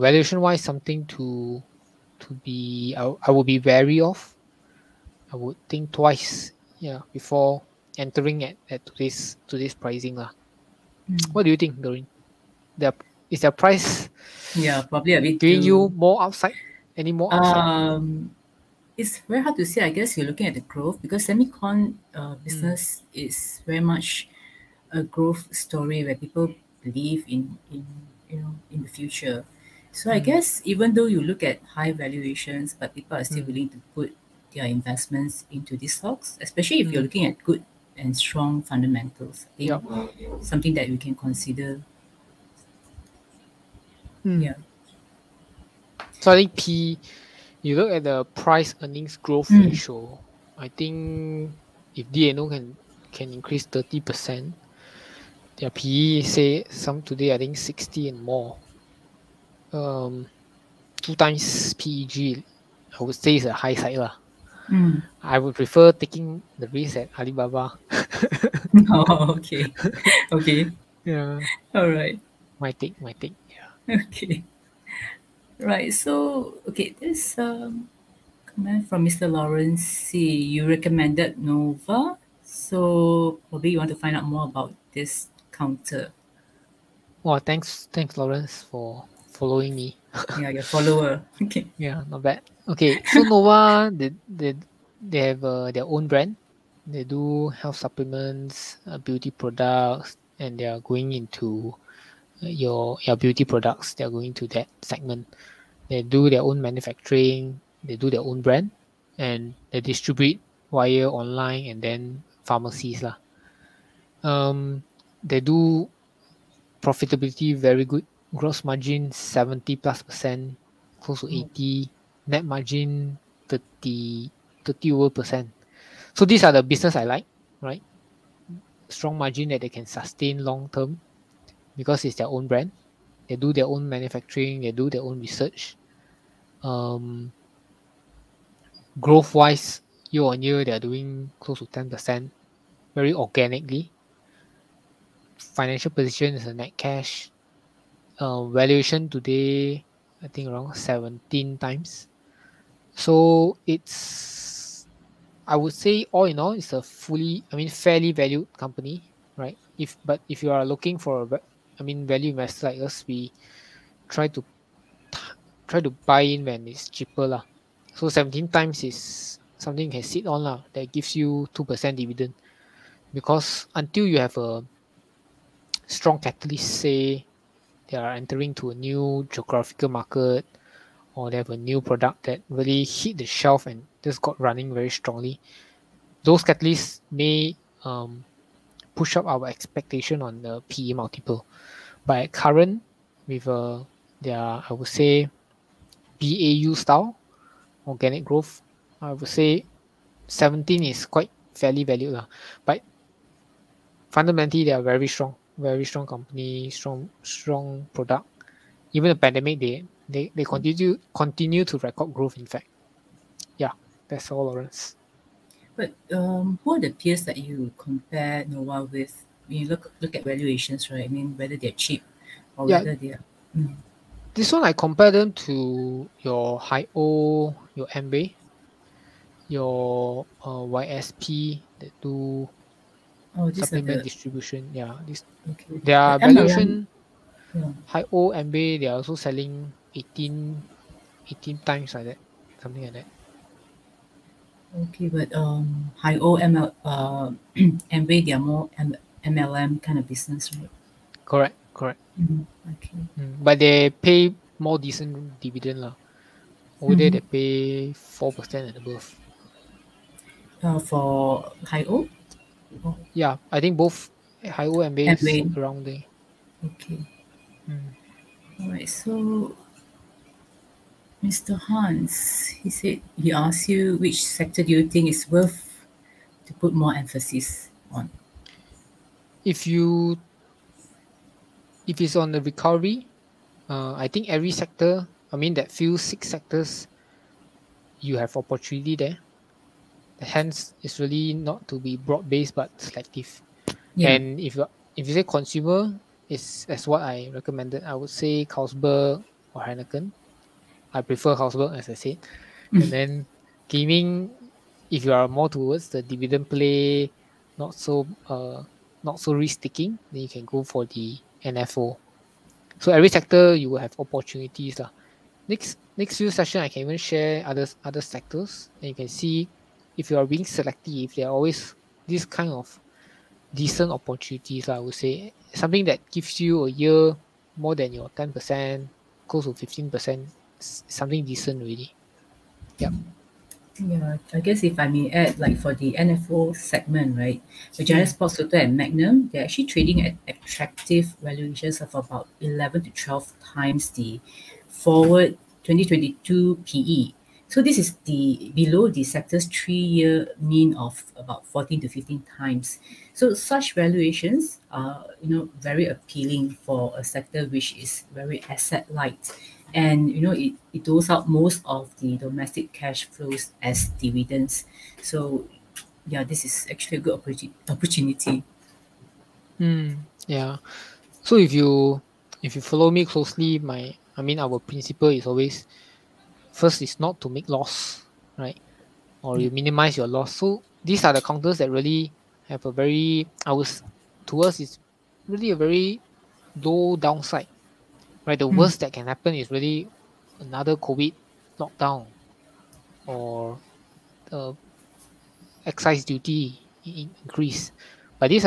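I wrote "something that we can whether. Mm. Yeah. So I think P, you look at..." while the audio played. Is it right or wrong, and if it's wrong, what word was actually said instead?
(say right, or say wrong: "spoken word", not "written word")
wrong: "consider", not "whether".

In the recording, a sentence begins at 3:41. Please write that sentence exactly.
I mean, whether they're cheap or yeah.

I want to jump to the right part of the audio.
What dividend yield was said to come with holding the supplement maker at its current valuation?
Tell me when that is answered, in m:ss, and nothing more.
2:51.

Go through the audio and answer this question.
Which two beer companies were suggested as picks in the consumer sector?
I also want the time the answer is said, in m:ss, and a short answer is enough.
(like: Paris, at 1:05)
Carlsberg or Heineken, at 4:58.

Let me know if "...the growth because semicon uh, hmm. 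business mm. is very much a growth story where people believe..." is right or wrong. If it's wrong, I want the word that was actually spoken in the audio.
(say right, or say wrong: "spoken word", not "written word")
right.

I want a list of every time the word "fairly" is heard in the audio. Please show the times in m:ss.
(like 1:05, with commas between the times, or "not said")
2:37, 3:21.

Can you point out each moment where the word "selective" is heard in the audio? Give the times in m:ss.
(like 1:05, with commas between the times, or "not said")
4:52, 5:20.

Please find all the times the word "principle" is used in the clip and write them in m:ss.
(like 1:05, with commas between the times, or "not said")
6:14.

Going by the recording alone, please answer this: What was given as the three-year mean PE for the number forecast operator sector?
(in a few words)
14 to 15 times.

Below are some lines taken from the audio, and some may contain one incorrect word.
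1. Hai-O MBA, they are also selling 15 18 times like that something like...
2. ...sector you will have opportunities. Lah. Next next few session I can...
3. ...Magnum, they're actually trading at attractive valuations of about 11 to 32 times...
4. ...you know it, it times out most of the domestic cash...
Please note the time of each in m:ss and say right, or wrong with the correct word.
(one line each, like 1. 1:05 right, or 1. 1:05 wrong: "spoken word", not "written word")
1. 3:57 wrong: "18", not "15"
2. 5:13 right
3. 5:38 wrong: "12", not "32"
4. 6:00 wrong: "doles", not "times".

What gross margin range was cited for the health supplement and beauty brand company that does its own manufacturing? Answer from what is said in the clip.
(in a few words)
70 plus percent.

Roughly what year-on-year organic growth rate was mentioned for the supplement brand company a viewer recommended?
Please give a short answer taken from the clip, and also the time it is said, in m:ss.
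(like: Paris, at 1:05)
close to 10%, at 2:21.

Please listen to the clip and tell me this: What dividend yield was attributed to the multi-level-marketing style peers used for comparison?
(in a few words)
4 percent and above.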